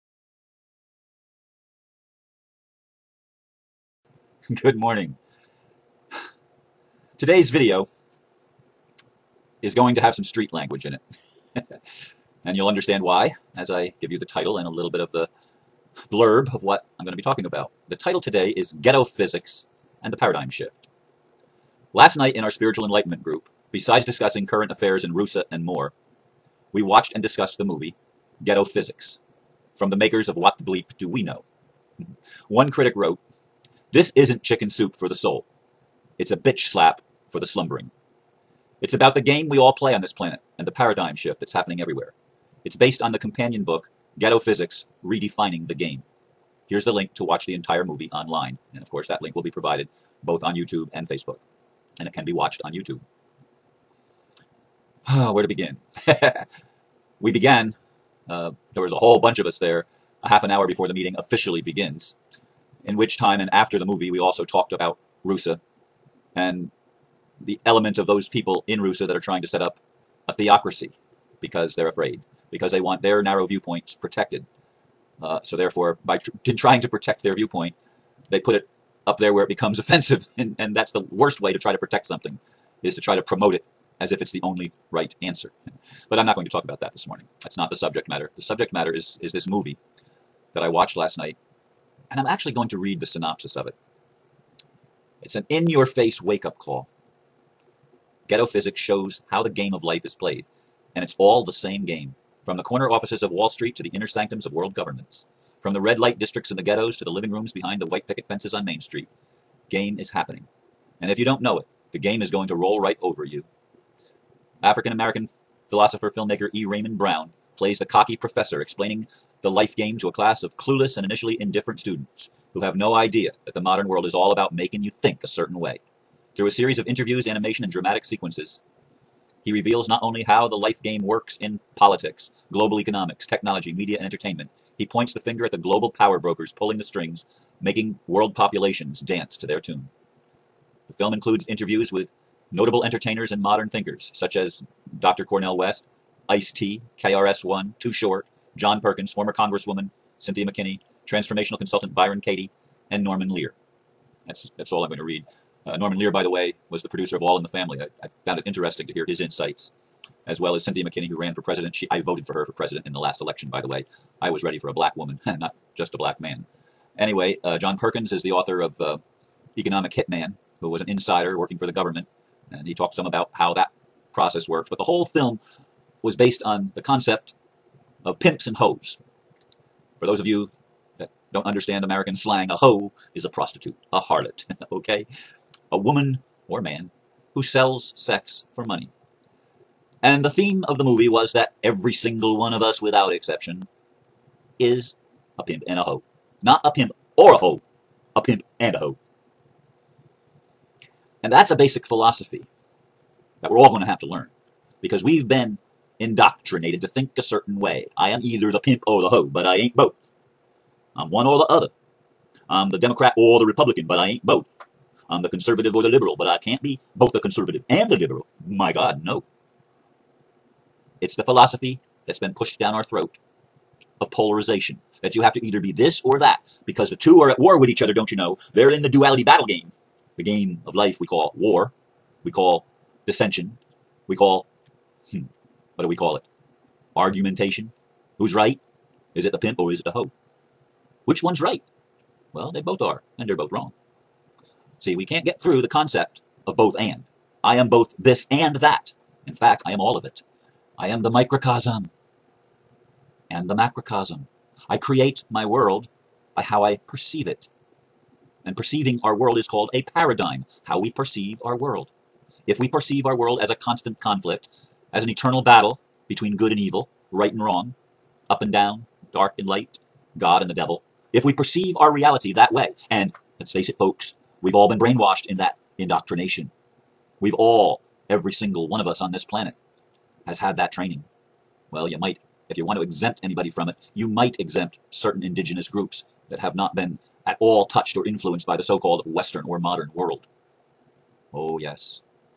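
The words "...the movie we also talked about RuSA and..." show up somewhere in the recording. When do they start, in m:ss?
1:03.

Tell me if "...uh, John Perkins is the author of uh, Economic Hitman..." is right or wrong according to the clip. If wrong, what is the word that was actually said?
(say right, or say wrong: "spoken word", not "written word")
right.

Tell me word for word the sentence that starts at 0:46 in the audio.
Here's the link to watch the entire movie online.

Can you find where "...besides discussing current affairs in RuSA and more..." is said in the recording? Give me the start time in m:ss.
0:23.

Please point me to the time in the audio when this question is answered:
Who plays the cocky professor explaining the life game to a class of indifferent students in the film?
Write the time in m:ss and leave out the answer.
1:56.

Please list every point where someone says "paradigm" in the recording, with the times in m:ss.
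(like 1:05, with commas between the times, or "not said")
0:20, 0:40, 4:19.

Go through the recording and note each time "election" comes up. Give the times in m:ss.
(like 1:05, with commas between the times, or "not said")
2:43.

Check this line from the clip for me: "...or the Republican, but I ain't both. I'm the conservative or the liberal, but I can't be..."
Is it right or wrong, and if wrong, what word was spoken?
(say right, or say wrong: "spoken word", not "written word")
right.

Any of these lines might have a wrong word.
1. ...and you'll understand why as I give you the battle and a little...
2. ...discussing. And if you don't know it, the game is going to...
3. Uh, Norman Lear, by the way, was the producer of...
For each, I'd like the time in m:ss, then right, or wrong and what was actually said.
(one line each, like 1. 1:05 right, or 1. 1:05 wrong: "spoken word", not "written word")
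1. 0:12 wrong: "title", not "battle"
2. 1:50 wrong: "happening", not "discussing"
3. 2:35 right.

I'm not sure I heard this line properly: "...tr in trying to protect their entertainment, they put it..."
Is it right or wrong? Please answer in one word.
wrong.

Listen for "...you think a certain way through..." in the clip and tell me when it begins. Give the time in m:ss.
2:04.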